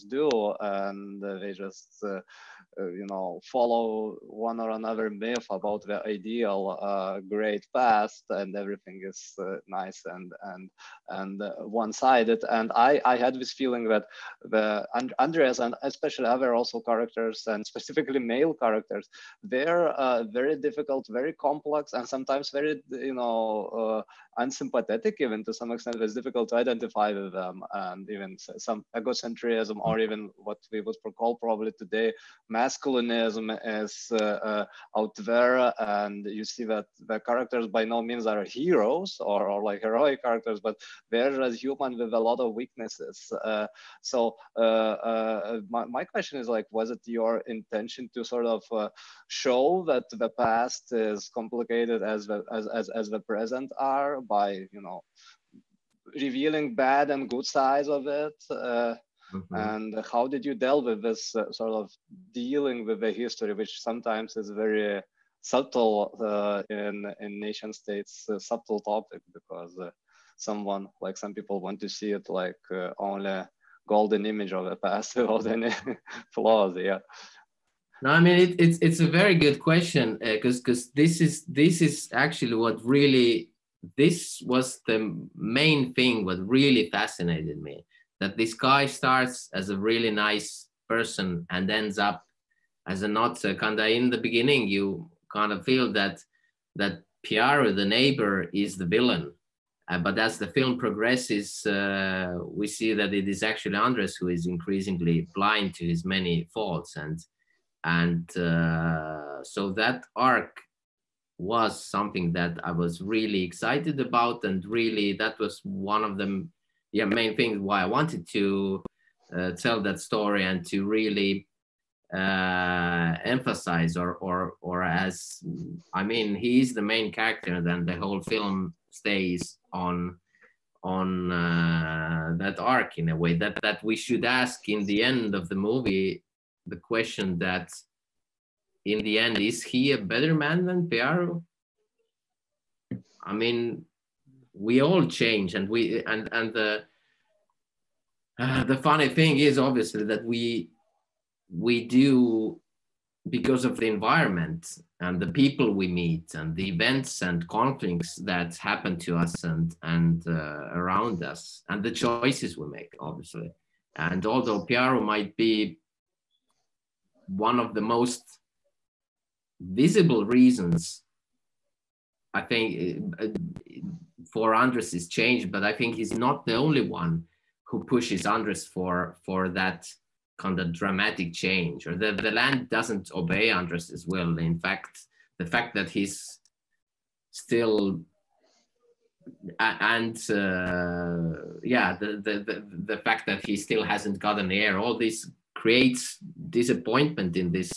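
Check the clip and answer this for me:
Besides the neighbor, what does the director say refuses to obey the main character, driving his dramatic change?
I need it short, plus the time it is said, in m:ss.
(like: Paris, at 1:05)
The land, at 3:02.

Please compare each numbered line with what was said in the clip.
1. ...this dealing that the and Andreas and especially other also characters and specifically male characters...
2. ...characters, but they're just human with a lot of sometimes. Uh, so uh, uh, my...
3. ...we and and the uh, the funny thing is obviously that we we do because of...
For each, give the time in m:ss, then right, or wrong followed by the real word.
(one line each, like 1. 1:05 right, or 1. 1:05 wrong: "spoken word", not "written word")
1. 0:13 wrong: "feeling", not "dealing"
2. 0:40 wrong: "weaknesses", not "sometimes"
3. 2:25 right.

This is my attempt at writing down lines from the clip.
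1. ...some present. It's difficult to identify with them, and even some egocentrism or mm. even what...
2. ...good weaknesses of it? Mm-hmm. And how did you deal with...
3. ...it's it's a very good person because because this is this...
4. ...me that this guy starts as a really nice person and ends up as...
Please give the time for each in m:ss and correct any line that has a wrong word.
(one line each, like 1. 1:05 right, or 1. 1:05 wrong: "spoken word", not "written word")
1. 0:25 wrong: "extent", not "present"
2. 0:57 wrong: "sides", not "weaknesses"
3. 1:18 wrong: "question", not "person"
4. 1:27 right.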